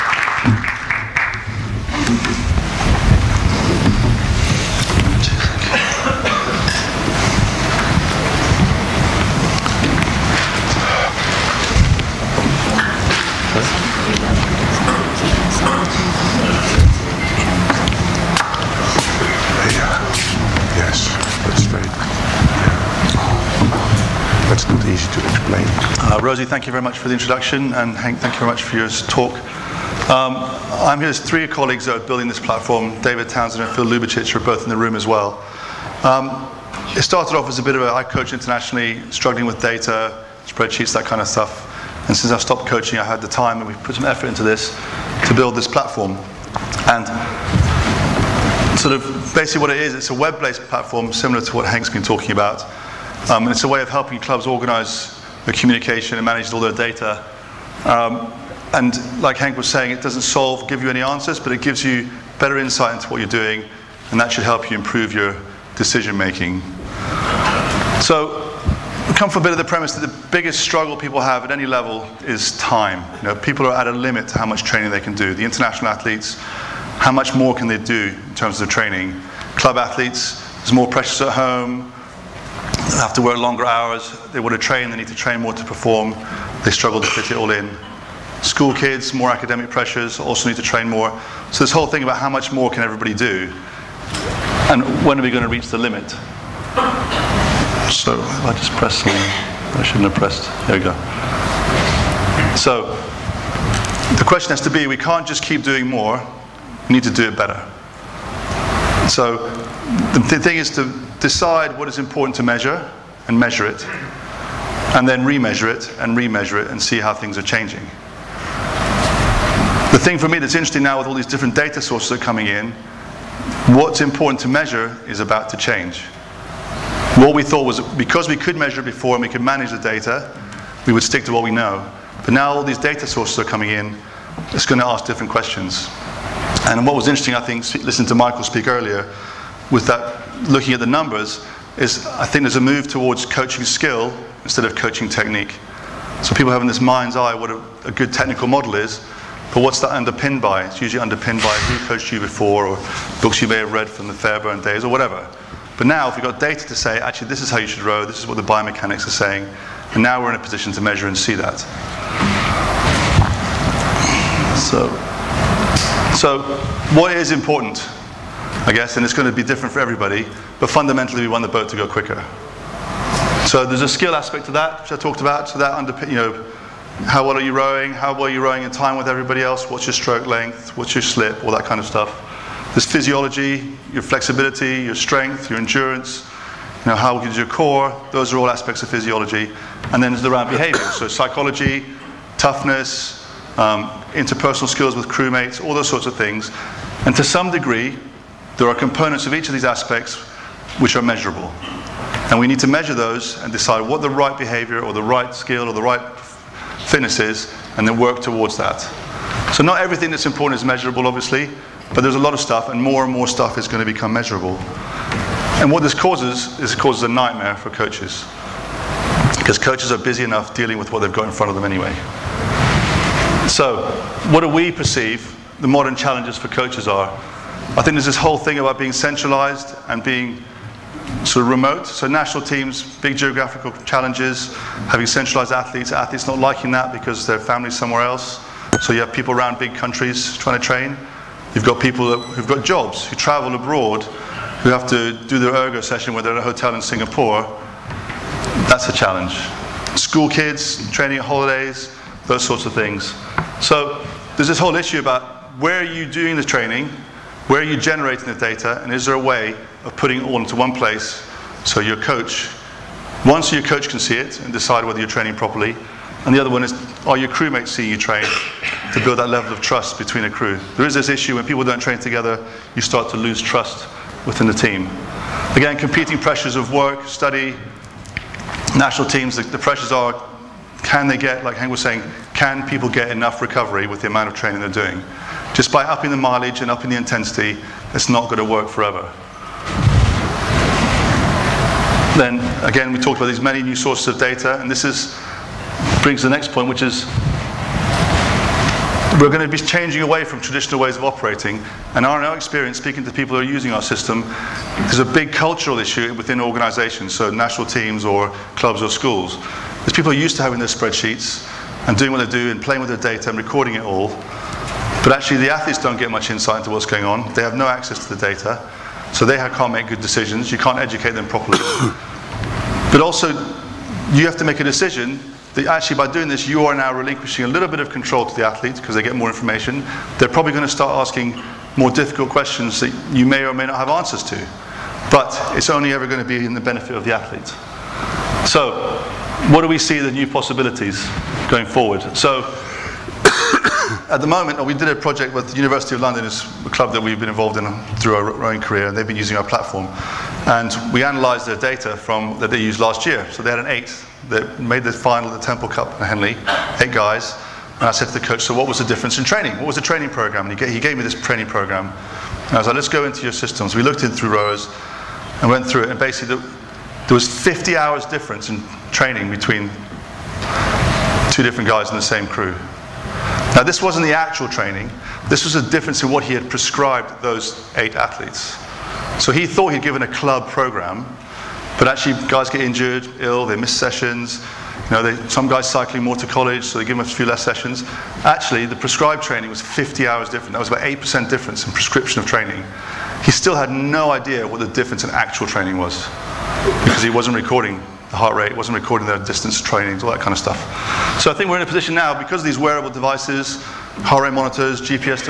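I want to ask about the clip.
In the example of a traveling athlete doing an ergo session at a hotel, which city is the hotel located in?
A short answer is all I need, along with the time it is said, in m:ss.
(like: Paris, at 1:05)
Singapore, at 4:06.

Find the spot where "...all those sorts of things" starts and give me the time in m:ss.
3:15.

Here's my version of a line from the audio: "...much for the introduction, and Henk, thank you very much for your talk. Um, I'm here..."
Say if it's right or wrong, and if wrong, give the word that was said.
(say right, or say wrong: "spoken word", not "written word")
right.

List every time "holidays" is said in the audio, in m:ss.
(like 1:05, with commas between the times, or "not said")
4:11.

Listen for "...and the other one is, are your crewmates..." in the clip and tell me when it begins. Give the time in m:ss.
4:26.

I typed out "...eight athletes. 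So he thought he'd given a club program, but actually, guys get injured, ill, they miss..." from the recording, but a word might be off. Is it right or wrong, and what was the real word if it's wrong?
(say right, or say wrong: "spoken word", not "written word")
right.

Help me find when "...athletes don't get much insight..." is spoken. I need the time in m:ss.
5:15.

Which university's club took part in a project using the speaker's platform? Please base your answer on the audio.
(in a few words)
University of London.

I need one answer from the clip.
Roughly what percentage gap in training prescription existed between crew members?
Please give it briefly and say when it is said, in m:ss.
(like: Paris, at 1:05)
8%, at 6:30.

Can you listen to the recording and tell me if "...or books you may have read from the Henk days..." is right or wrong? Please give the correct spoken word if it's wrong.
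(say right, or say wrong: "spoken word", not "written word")
wrong: "Fairbairn", not "Henk".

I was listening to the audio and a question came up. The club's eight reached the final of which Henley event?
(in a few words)
Temple Cup.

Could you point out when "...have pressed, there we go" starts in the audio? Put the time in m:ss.
1:40.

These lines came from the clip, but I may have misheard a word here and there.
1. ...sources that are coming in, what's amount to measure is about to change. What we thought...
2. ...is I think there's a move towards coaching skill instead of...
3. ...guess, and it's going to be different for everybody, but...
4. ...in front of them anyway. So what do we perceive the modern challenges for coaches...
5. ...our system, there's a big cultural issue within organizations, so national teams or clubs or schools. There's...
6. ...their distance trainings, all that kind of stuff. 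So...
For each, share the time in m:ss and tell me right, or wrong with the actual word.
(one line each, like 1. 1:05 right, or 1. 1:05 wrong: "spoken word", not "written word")
1. 2:01 wrong: "important", not "amount"
2. 2:21 right
3. 2:48 right
4. 3:41 right
5. 5:03 right
6. 6:39 right.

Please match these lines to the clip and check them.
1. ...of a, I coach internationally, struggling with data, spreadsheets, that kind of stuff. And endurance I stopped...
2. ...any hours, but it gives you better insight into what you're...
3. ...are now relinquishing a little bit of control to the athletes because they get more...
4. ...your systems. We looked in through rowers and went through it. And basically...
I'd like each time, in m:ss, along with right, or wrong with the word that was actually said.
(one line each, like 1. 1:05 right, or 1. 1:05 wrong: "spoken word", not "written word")
1. 0:37 wrong: "since", not "endurance"
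2. 1:00 wrong: "answers", not "hours"
3. 5:26 right
4. 6:03 right.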